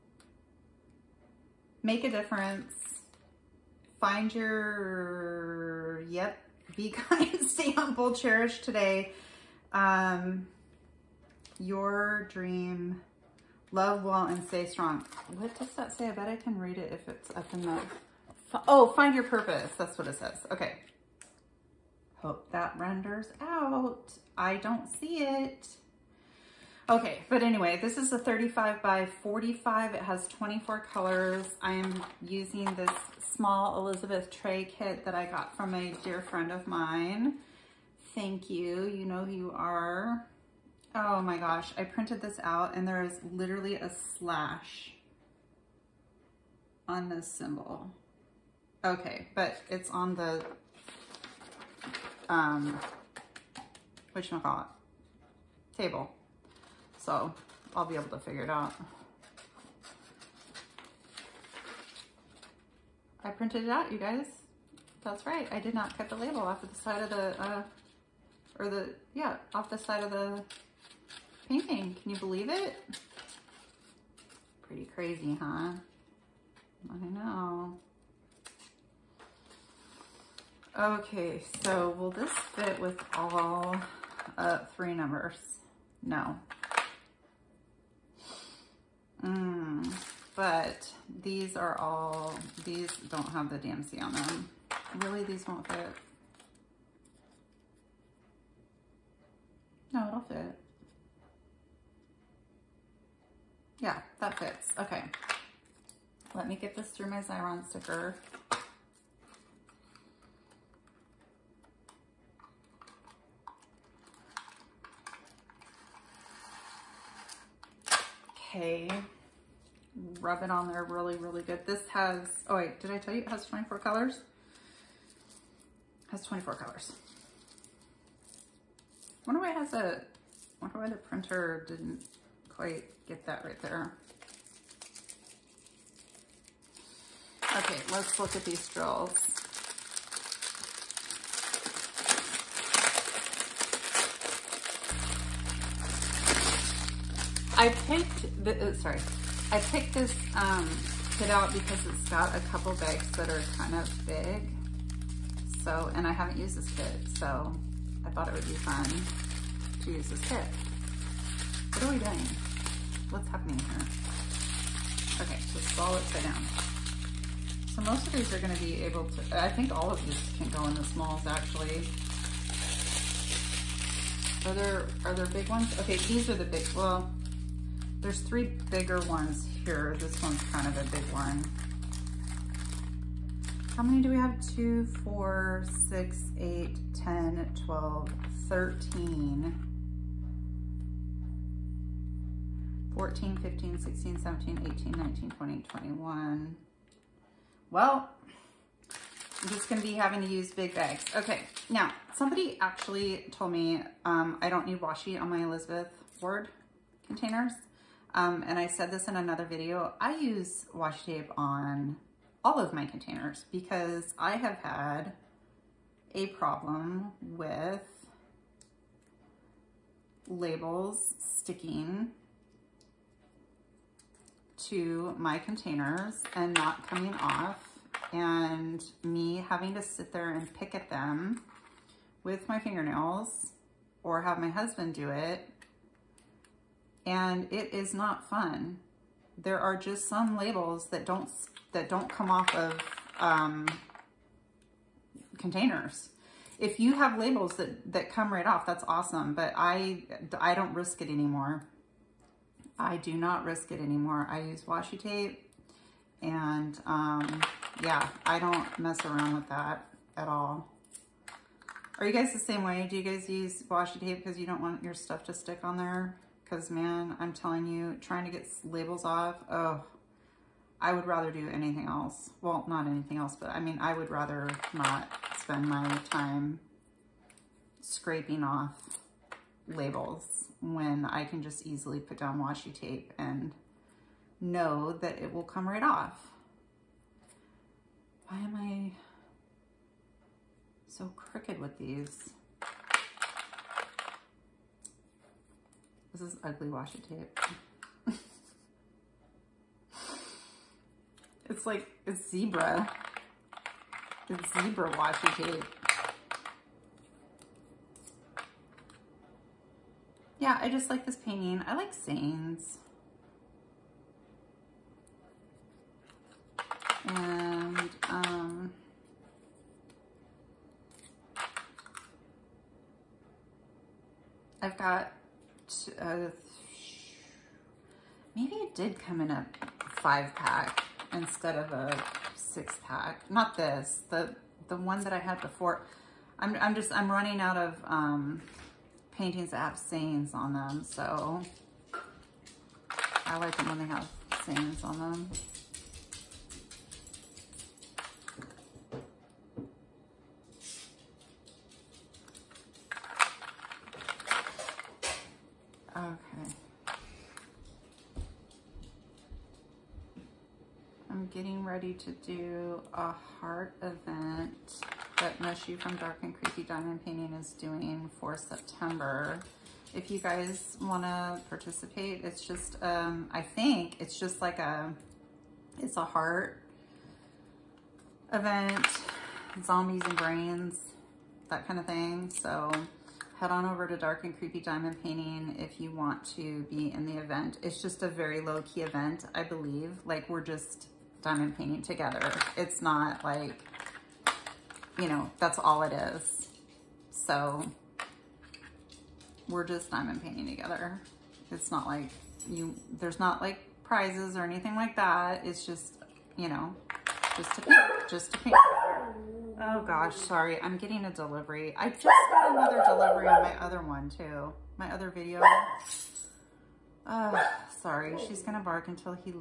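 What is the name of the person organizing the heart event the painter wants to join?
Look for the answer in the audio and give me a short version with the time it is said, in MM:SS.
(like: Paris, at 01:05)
Mushy, at 06:05.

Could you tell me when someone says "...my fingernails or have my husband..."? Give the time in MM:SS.
03:52.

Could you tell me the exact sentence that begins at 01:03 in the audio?
I printed it out, you guys.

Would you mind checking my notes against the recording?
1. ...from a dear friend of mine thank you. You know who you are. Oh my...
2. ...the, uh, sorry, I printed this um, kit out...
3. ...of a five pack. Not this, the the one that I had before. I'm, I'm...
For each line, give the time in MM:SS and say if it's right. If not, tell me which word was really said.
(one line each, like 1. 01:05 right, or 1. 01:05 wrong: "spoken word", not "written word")
1. 00:35 right
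2. 02:28 wrong: "picked", not "printed"
3. 05:31 wrong: "six", not "five".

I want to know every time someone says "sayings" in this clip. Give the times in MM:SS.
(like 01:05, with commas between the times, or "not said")
05:39, 05:44.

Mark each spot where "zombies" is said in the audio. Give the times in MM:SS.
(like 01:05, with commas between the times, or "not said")
06:19.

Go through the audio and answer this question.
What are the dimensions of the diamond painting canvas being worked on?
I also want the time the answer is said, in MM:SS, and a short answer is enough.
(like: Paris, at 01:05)
35 by 45, at 00:28.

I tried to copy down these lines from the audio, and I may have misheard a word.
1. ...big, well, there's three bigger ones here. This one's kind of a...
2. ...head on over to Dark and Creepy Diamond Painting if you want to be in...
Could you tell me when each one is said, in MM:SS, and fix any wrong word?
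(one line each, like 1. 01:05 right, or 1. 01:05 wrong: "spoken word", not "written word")
1. 02:56 right
2. 06:23 right.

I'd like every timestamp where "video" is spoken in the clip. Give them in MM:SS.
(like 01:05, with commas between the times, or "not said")
03:29, 06:55.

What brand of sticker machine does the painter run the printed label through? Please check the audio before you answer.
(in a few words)
Xyron.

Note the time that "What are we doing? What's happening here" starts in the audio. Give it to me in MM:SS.
02:41.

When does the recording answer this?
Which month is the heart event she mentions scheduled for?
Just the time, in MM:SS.
06:08.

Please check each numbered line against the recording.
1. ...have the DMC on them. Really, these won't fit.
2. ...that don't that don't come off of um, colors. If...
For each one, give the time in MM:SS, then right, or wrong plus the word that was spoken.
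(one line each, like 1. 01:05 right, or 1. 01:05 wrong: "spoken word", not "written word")
1. 01:33 right
2. 04:00 wrong: "containers", not "colors".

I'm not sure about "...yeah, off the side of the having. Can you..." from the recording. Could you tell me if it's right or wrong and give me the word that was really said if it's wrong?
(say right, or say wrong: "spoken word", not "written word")
wrong: "painting", not "having".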